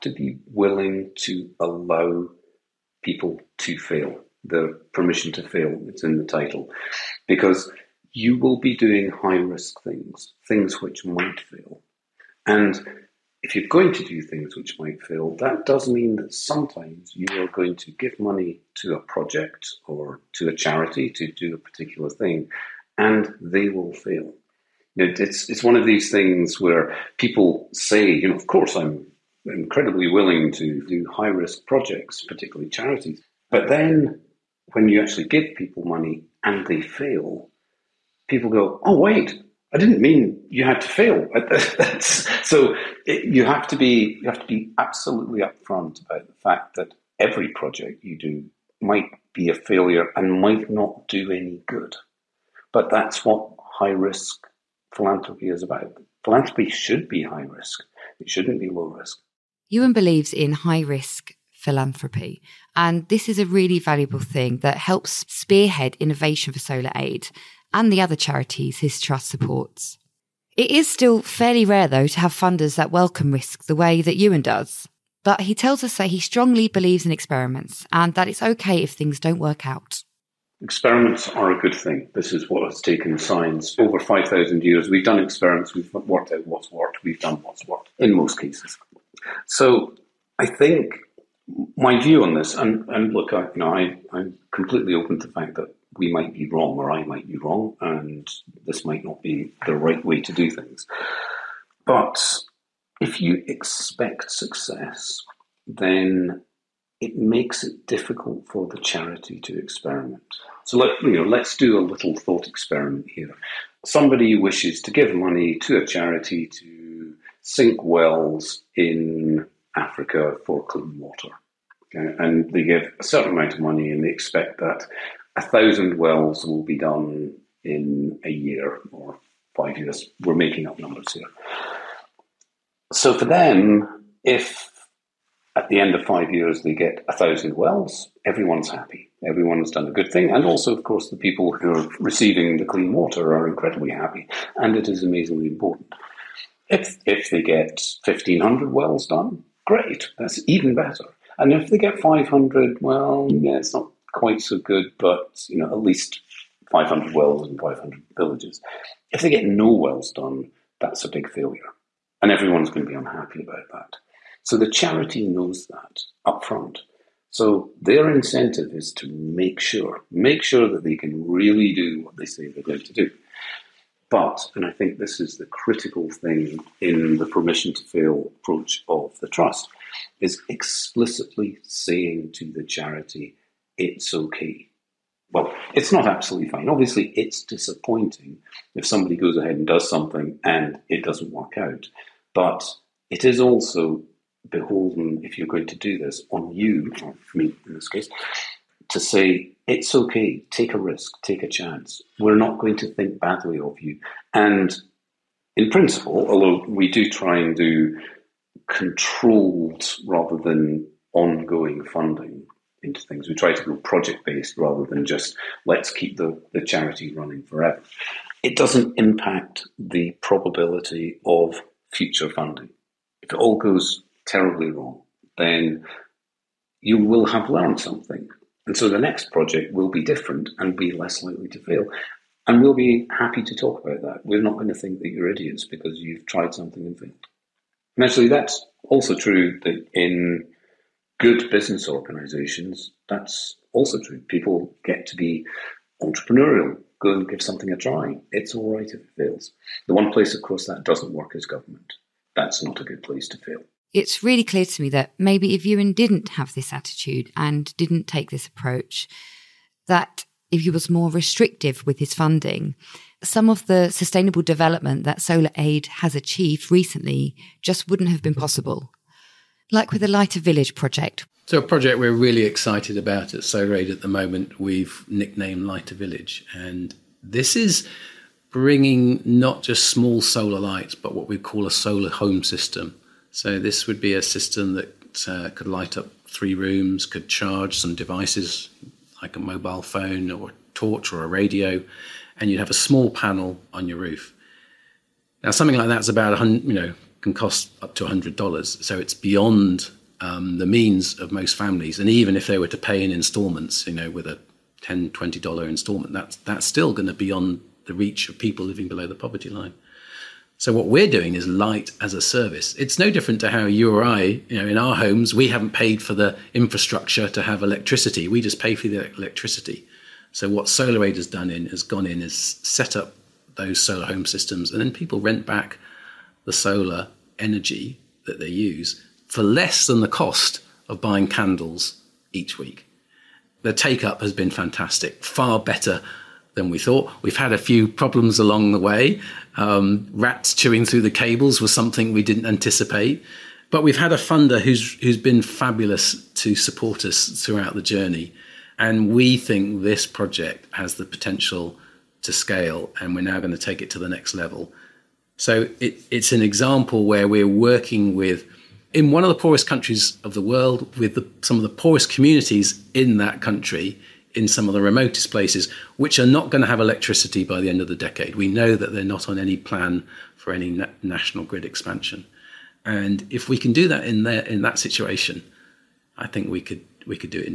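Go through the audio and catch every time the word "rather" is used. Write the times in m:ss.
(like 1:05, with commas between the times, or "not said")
3:30, 3:34.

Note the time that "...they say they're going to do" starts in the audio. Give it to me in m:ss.
2:52.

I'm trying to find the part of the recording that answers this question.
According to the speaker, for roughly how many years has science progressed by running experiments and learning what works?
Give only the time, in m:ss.
1:23.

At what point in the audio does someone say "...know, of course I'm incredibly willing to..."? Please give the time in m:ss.
0:28.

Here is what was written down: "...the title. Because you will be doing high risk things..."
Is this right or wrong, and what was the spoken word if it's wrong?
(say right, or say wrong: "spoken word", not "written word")
right.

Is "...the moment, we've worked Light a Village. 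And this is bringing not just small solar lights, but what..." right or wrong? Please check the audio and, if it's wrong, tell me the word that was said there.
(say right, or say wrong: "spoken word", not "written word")
wrong: "nicknamed", not "worked".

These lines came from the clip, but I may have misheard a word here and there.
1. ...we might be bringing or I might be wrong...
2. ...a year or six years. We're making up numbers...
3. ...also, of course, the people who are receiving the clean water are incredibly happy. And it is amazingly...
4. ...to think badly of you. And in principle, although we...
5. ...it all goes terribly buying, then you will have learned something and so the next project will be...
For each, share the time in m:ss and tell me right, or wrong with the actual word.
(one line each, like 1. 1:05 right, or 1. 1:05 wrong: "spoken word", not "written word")
1. 1:35 wrong: "wrong", not "bringing"
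2. 2:08 wrong: "five", not "six"
3. 2:20 right
4. 3:22 right
5. 3:43 wrong: "wrong", not "buying".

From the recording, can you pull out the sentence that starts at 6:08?
We know that they're not on any plan for any na- national grid expansion.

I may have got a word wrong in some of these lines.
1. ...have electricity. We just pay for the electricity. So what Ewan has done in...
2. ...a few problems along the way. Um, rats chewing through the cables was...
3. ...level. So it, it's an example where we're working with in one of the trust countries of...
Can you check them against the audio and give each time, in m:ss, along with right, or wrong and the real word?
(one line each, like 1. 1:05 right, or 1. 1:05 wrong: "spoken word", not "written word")
1. 5:17 wrong: "SolarAid", not "Ewan"
2. 5:37 right
3. 5:54 wrong: "poorest", not "trust".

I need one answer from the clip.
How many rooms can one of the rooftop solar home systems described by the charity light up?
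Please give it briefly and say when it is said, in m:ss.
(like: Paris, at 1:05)
3, at 4:46.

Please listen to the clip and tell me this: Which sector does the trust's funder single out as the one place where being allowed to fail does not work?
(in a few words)
government.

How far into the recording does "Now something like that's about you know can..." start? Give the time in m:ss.
4:55.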